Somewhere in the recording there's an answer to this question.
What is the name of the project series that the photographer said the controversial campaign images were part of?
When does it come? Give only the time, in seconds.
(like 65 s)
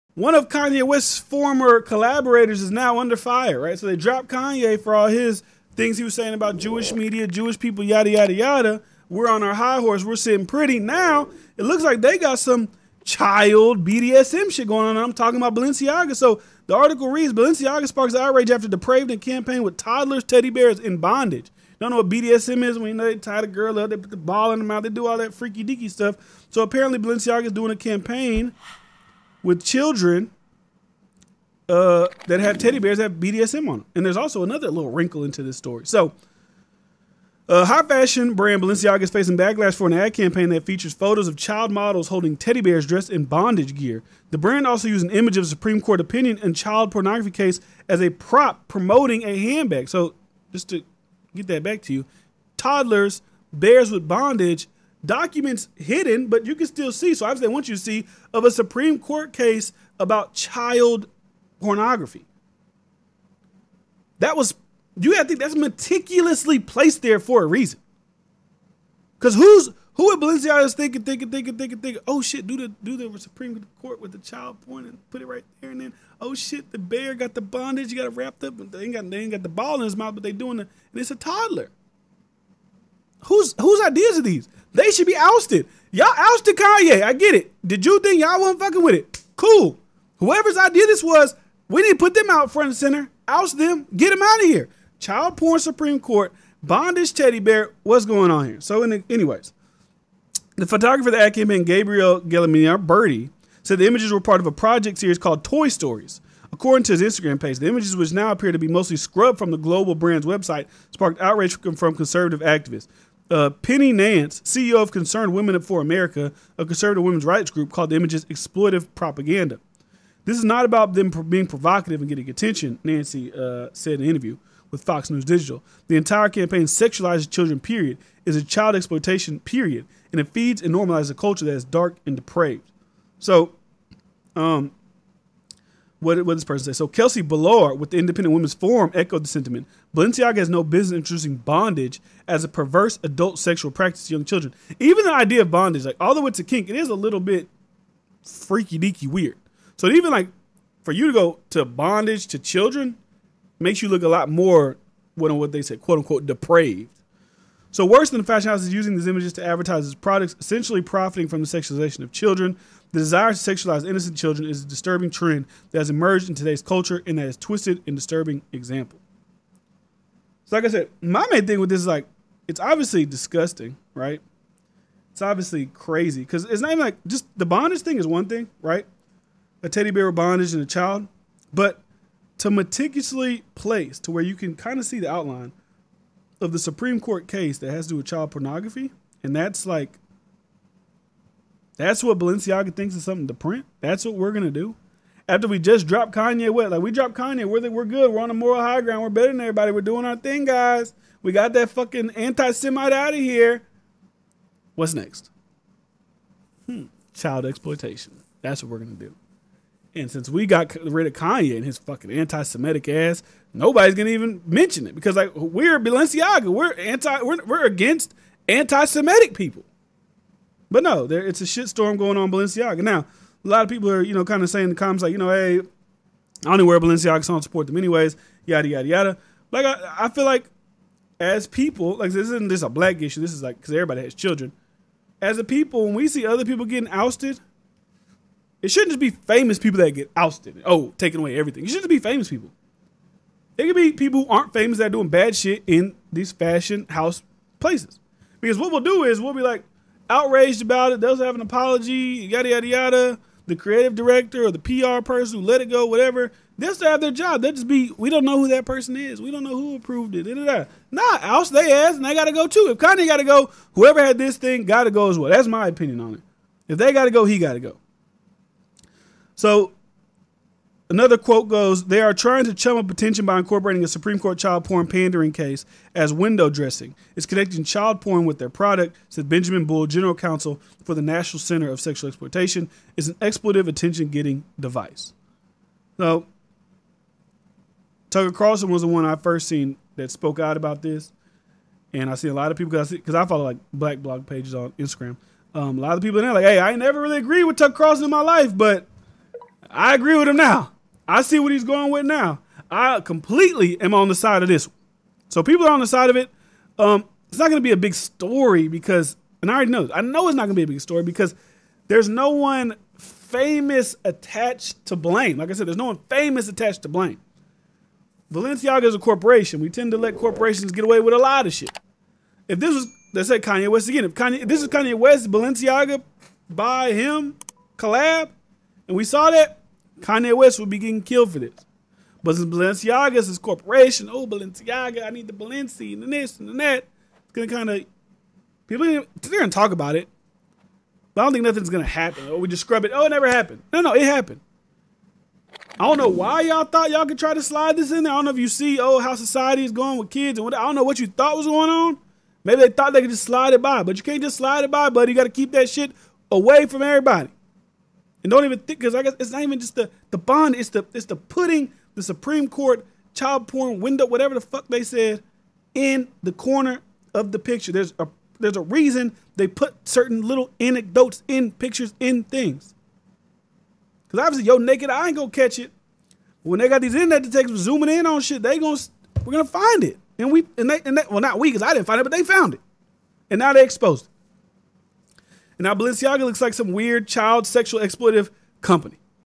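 105 s.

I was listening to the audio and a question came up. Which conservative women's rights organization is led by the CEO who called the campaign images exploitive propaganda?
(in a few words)
Concerned Women for America.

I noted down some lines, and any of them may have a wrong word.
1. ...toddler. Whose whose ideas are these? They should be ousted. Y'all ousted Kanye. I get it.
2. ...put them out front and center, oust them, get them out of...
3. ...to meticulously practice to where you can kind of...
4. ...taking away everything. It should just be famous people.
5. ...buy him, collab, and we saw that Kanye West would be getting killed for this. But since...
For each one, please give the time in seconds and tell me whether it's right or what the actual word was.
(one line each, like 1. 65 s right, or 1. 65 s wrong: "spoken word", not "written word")
1. 81 s right
2. 91 s right
3. 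182 s wrong: "place", not "practice"
4. 240 s right
5. 326 s right.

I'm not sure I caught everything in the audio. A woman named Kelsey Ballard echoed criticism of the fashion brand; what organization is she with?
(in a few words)
Independent Women's Forum.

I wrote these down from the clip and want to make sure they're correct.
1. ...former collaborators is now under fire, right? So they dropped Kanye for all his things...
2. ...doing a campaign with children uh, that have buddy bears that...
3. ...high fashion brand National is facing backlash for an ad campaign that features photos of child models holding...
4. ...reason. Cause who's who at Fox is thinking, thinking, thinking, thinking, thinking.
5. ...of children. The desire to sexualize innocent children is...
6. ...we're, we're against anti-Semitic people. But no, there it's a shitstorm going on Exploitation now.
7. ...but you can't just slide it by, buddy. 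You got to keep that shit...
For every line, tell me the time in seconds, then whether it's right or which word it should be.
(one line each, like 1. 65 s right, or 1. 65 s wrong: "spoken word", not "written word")
1. 1 s right
2. 27 s wrong: "teddy", not "buddy"
3. 37 s wrong: "Balenciaga", not "National"
4. 67 s wrong: "Balenciaga", not "Fox"
5. 162 s right
6. 217 s wrong: "Balenciaga", not "Exploitation"
7. 353 s right.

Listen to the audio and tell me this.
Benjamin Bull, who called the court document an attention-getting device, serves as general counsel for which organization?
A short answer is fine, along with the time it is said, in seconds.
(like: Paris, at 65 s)
National Center of Sexual Exploitation, at 281 s.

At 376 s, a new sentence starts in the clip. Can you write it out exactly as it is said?
When they got these internet detectives zooming in on shit, they gonna we're gonna find it.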